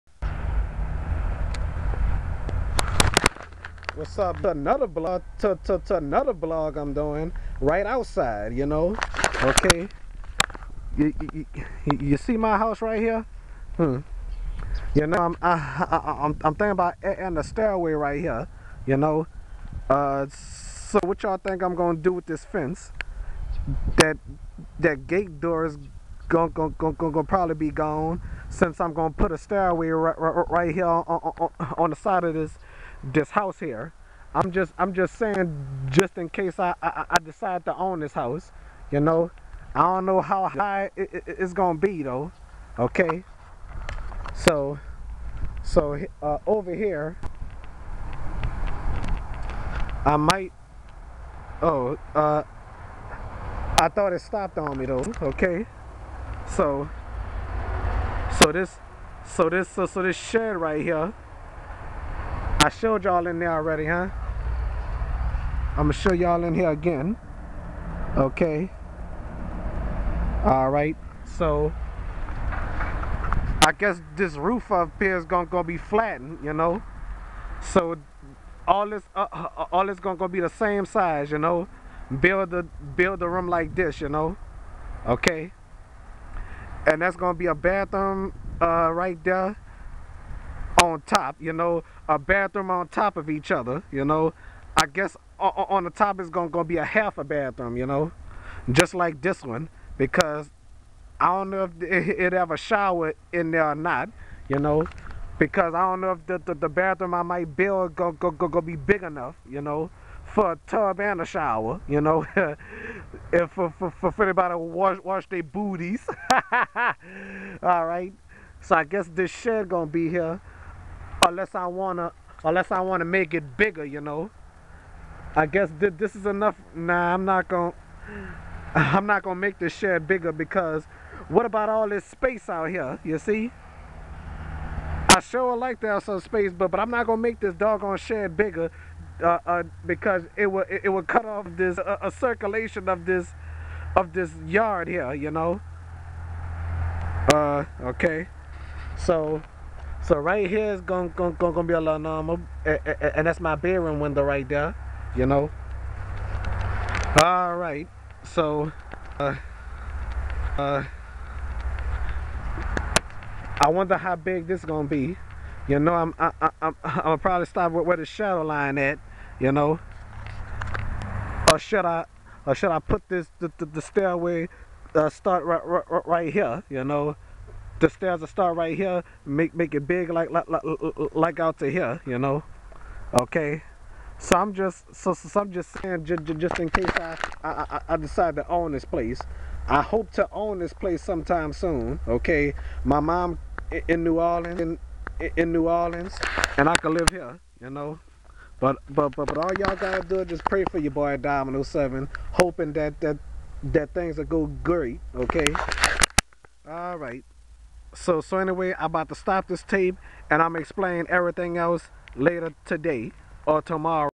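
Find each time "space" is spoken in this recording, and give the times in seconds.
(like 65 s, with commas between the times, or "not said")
132 s, 136 s.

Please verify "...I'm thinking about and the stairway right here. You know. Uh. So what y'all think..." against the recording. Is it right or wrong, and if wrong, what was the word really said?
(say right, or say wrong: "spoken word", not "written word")
right.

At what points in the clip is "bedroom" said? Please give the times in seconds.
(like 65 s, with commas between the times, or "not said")
153 s.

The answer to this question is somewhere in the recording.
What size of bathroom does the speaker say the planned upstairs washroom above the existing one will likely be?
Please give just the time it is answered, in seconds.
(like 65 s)
96 s.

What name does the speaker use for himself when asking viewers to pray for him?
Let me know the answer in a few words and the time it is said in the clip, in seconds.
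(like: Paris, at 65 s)
Domino Seven, at 201 s.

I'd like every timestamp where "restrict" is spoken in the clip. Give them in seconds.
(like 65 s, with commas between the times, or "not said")
not said.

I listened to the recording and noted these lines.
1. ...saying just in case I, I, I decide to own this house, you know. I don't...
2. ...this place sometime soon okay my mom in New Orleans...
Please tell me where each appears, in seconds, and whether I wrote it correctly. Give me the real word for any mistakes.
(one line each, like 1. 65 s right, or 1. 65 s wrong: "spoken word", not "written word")
1. 35 s right
2. 190 s right.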